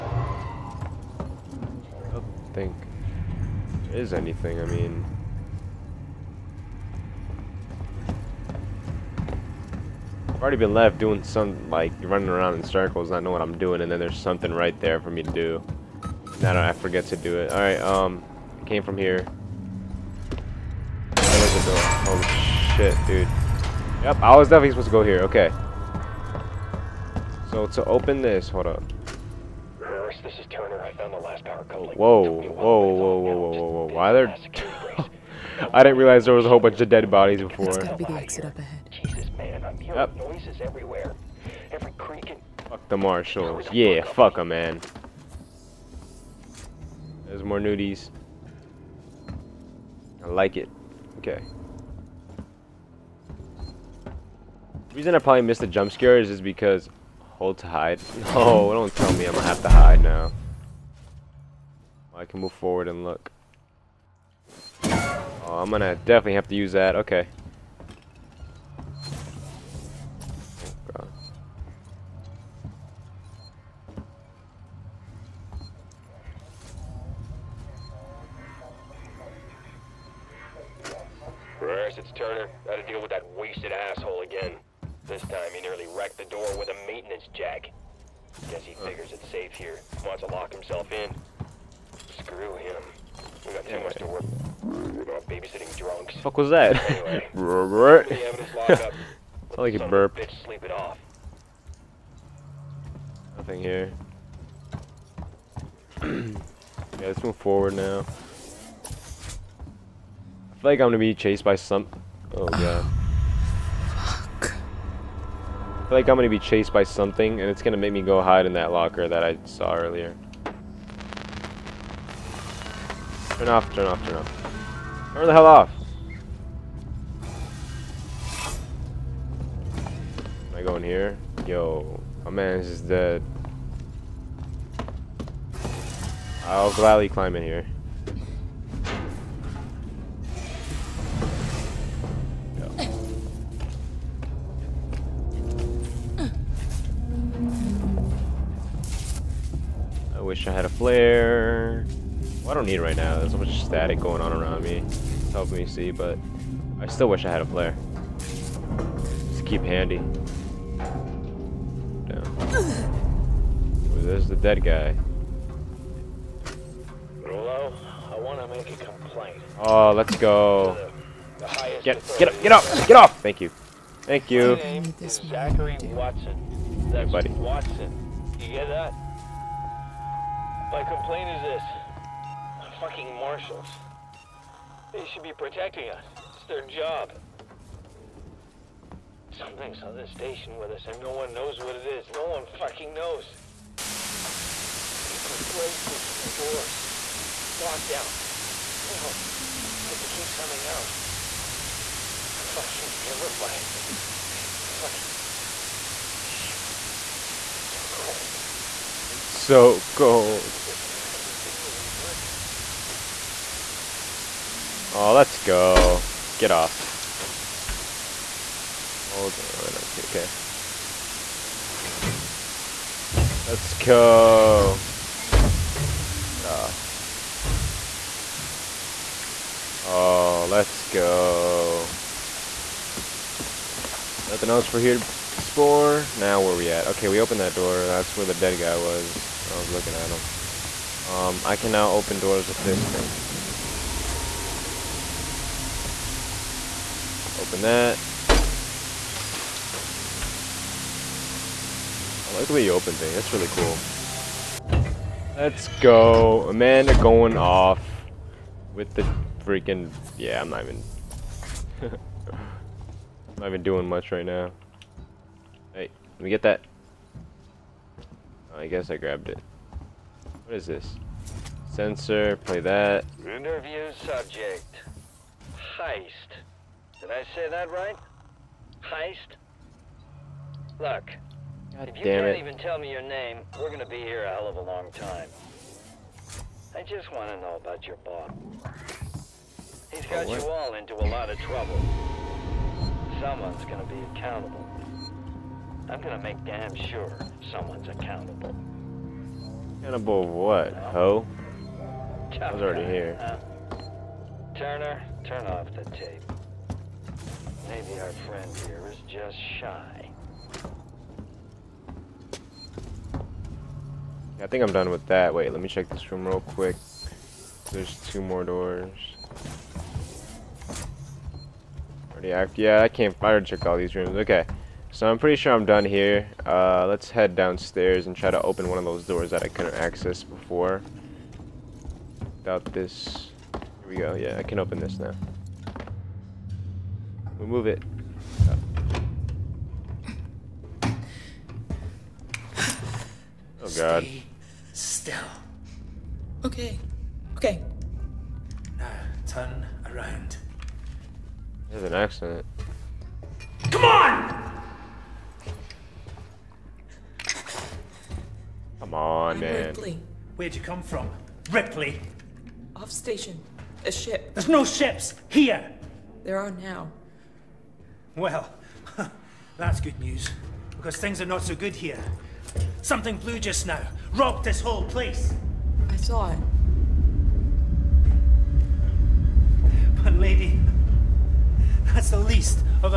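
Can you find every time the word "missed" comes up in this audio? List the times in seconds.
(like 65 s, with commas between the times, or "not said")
55 s.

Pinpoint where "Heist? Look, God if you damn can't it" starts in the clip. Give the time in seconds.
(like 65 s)
278 s.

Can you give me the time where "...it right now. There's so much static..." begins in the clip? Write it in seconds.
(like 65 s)
152 s.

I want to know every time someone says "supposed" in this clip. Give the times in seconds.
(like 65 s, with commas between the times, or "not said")
24 s.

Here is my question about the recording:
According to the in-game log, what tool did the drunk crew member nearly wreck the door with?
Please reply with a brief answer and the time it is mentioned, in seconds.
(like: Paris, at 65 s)
maintenance jack, at 86 s.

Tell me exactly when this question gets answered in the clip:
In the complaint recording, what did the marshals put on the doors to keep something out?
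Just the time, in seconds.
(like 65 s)
195 s.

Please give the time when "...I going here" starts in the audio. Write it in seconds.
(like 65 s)
130 s.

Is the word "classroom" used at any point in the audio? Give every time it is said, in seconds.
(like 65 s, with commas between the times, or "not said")
not said.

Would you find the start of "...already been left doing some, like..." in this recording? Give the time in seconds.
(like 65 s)
10 s.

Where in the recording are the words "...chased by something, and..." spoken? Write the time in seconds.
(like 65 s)
116 s.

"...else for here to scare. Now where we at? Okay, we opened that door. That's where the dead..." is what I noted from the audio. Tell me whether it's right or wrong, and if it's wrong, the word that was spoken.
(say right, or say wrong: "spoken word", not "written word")
wrong: "explore", not "scare".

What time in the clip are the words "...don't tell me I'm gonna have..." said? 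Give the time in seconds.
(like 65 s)
58 s.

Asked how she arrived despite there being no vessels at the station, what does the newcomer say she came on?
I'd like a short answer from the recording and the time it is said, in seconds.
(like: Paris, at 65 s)
a ship, at 363 s.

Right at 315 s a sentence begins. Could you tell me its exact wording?
Wait, let me check this room real quick.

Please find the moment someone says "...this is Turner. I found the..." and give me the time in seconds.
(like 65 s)
30 s.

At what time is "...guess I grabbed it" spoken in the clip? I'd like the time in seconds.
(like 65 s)
268 s.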